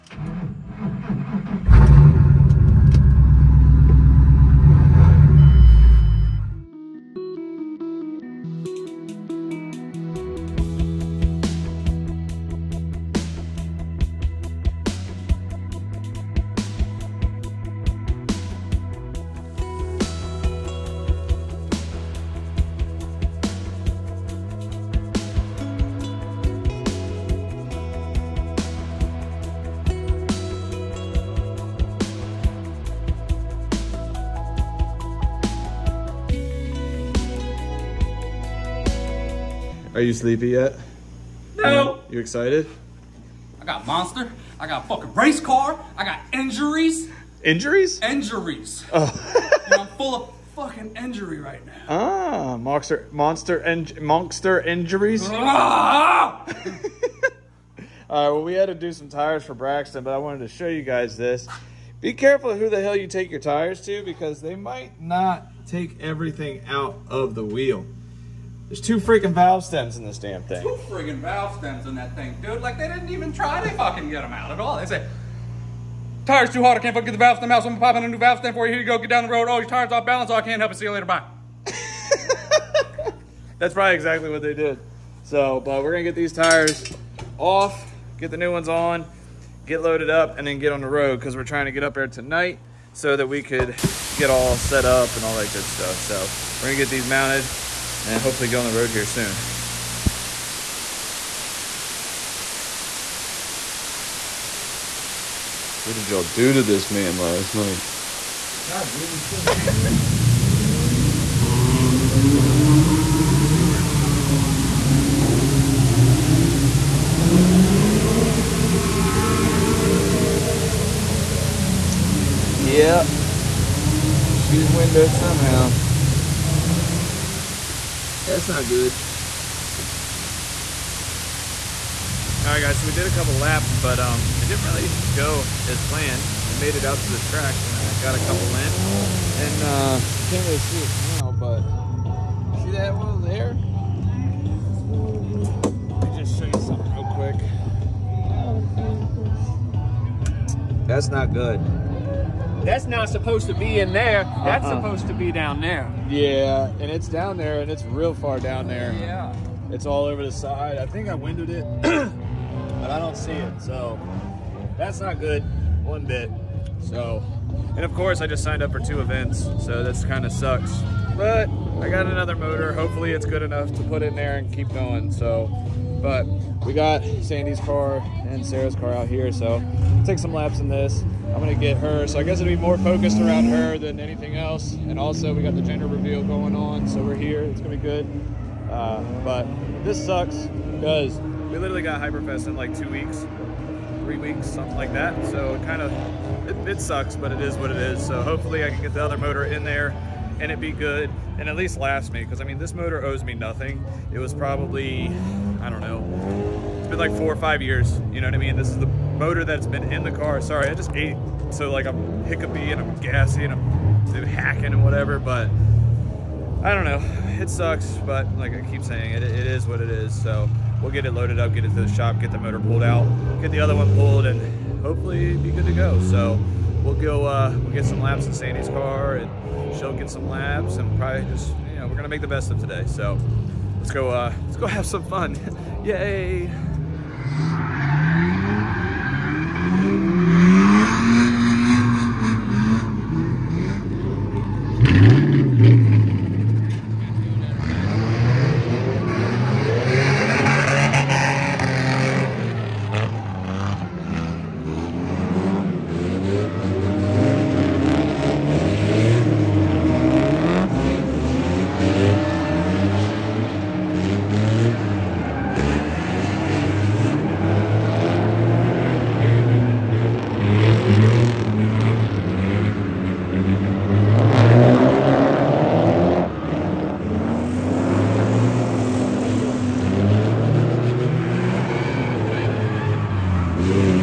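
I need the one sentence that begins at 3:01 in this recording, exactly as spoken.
I'm gonna get her, so I guess it'll be more focused around her than anything else.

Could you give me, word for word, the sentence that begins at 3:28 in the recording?
This is the motor that's been in the car.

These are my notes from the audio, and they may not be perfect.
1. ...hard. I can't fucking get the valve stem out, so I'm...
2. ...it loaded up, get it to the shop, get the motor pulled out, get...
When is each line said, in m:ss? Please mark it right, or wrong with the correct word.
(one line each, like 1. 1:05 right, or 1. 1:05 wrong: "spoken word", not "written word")
1. 1:16 right
2. 3:41 right.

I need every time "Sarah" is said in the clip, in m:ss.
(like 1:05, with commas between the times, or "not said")
2:58.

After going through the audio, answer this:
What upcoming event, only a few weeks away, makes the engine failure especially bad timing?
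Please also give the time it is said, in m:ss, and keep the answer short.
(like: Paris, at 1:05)
Hyperfest, at 3:11.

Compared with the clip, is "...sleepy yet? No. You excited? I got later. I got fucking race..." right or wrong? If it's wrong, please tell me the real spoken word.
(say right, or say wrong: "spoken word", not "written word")
wrong: "monster", not "later".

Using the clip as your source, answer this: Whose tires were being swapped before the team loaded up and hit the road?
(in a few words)
Braxton.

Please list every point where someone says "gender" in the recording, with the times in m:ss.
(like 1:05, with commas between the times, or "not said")
3:05.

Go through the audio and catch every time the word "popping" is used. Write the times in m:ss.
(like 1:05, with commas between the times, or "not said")
1:17.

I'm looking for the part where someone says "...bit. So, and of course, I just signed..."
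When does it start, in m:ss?
2:46.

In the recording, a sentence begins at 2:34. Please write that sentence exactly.
That's uh supposed to be down there.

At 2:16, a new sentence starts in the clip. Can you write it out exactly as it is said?
We made it out to the track, and I got a couple in.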